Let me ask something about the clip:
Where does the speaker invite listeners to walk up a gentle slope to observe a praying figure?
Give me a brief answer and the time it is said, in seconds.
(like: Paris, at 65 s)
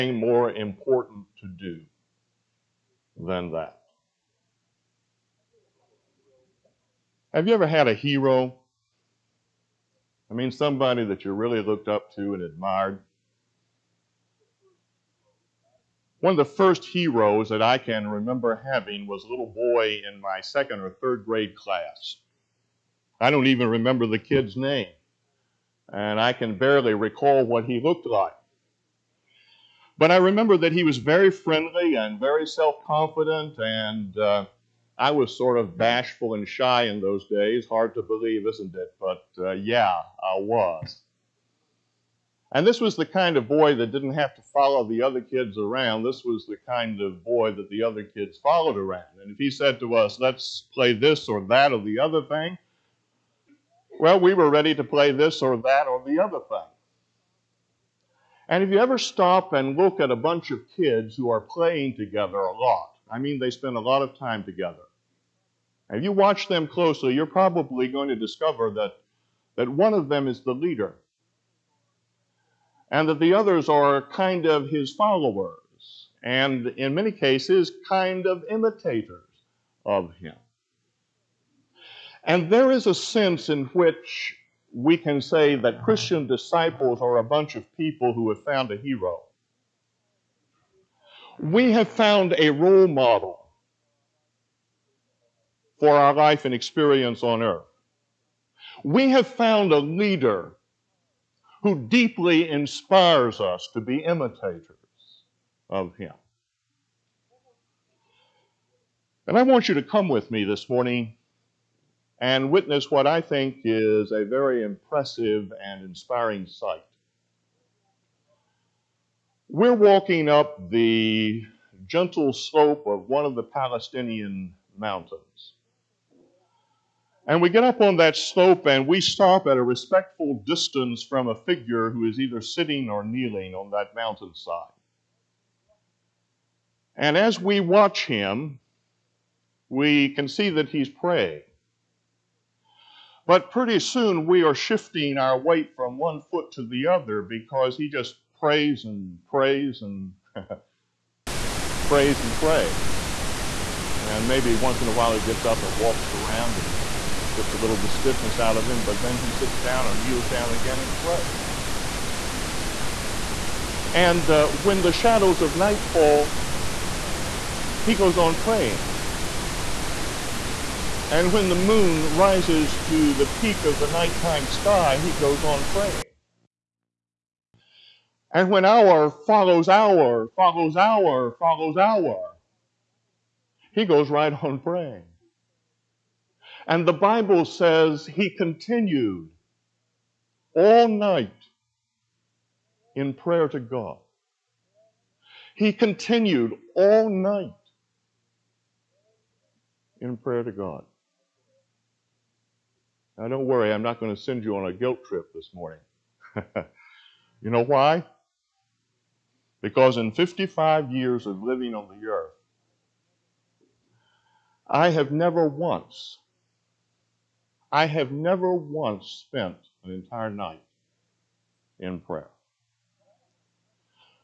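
Palestinian mountains, at 123 s.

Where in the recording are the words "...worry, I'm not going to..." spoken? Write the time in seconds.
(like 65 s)
203 s.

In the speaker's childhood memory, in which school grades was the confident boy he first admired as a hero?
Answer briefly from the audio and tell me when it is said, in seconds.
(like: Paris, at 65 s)
second or third grade, at 20 s.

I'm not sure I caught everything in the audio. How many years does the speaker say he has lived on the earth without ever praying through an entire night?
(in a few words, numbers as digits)
55.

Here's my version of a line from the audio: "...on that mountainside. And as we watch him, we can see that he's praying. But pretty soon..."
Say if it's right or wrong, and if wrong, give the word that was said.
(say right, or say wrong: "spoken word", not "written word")
right.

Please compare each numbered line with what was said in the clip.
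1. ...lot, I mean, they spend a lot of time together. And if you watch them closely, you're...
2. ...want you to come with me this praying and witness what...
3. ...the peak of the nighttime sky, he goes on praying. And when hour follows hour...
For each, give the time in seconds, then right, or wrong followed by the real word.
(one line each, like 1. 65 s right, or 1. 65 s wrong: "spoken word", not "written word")
1. 62 s right
2. 109 s wrong: "morning", not "praying"
3. 173 s right.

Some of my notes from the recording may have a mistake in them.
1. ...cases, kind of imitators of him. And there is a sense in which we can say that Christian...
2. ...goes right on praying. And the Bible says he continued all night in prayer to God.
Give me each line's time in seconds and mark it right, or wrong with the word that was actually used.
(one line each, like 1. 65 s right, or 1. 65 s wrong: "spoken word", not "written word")
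1. 77 s right
2. 183 s right.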